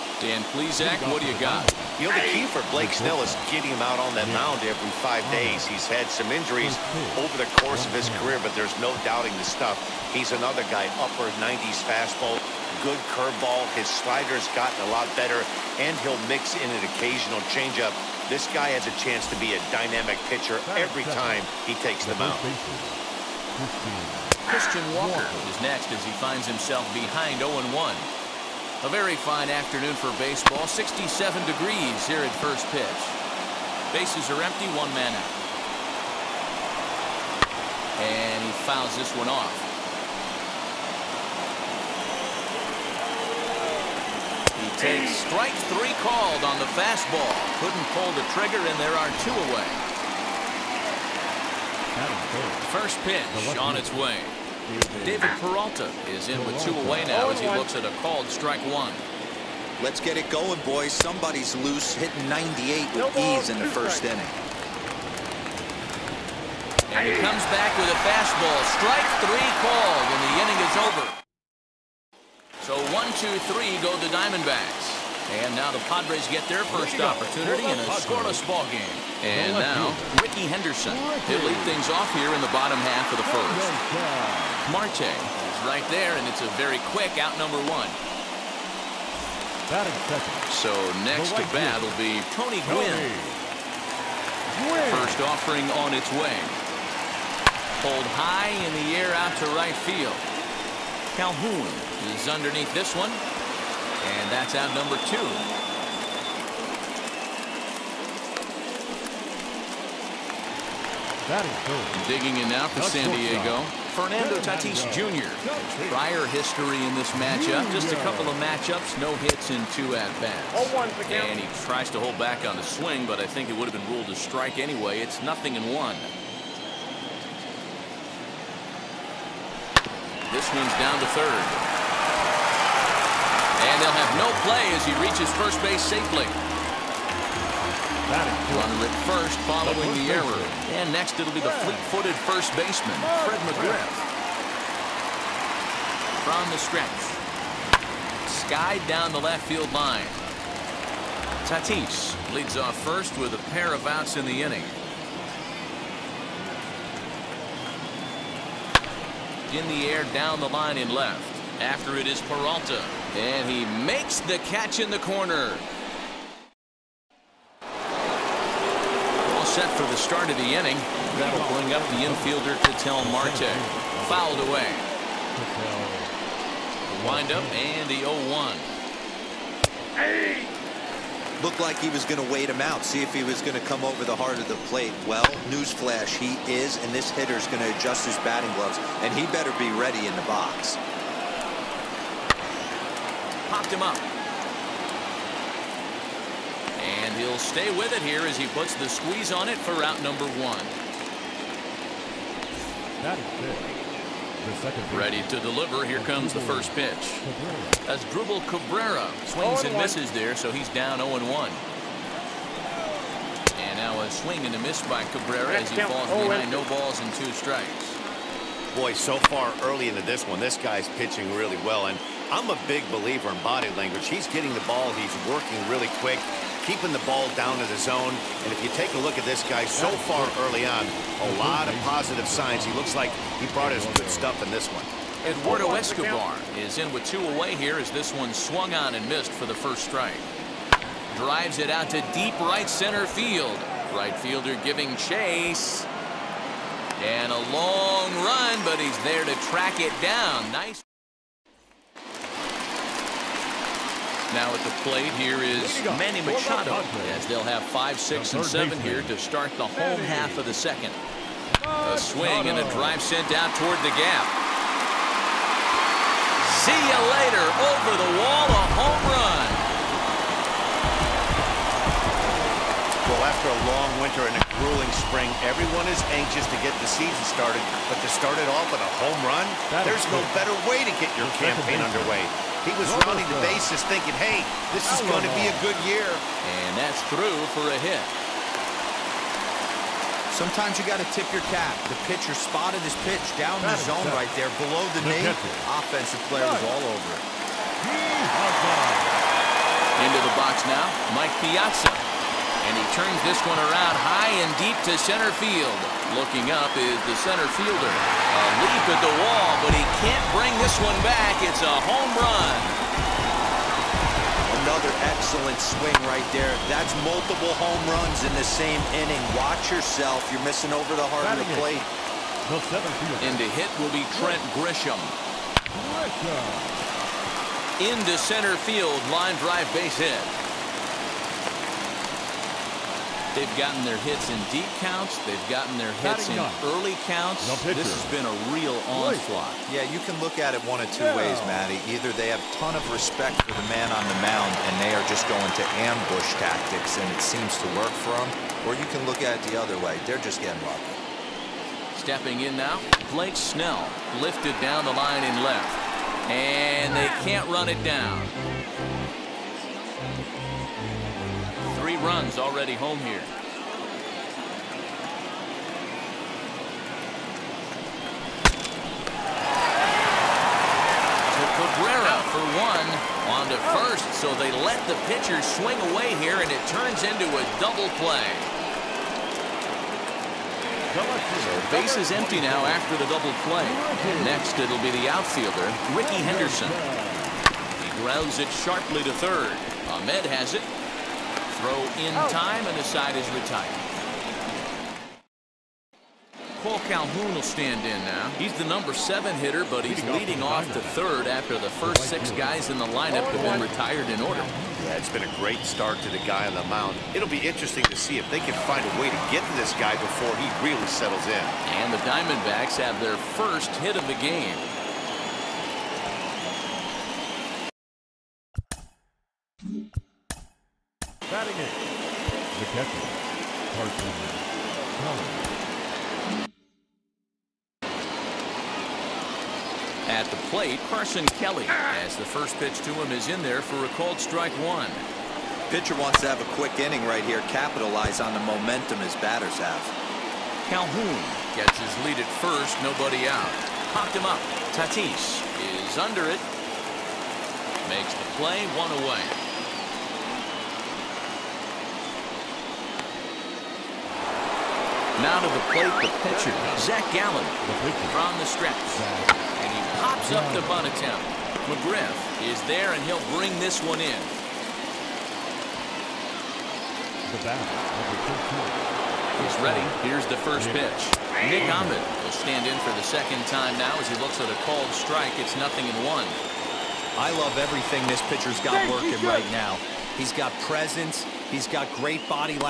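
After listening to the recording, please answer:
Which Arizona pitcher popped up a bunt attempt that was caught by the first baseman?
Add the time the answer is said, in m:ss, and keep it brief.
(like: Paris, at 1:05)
Zach Gallen, at 7:36.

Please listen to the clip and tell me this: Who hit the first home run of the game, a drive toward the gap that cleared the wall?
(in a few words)
Manny Machado.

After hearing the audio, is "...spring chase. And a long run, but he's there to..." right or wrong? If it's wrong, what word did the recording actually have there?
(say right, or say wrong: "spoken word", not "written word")
wrong: "giving", not "spring".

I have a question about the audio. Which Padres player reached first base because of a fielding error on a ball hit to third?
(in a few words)
Fernando Tatis Jr.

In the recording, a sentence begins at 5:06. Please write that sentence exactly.
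Looking up is the center fielder.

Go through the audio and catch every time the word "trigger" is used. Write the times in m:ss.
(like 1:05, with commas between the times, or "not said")
0:48.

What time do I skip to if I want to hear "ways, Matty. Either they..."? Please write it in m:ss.
5:41.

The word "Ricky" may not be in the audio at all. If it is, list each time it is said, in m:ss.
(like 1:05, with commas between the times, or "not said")
1:20, 6:25.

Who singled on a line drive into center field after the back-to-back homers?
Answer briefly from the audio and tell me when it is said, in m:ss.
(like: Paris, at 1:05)
Trent Grisham, at 5:24.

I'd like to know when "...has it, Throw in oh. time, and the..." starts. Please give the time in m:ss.
6:30.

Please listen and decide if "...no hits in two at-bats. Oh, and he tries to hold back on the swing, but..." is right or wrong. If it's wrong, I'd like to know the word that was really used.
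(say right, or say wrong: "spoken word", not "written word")
right.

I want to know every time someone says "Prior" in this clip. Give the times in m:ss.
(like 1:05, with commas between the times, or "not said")
1:55.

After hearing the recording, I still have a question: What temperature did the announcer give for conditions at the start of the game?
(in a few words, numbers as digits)
67 degrees.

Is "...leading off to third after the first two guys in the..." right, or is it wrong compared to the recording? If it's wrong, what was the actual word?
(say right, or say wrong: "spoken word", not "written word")
wrong: "six", not "two".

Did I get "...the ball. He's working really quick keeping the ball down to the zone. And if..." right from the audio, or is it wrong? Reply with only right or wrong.
right.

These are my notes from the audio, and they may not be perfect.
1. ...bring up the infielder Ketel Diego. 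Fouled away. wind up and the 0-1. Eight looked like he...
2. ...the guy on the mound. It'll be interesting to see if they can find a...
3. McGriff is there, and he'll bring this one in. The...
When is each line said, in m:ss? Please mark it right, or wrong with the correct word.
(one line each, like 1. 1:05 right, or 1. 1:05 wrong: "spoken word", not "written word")
1. 2:51 wrong: "Marte", not "Diego"
2. 6:46 right
3. 7:41 right.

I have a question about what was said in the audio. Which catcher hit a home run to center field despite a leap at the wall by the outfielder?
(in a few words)
Mike Piazza.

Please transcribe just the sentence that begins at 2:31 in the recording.
Tatis leads off first with a pair of outs in the inning.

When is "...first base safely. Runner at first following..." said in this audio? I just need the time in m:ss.
2:15.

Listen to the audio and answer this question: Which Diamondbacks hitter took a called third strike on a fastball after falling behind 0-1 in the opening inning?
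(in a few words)
Christian Walker.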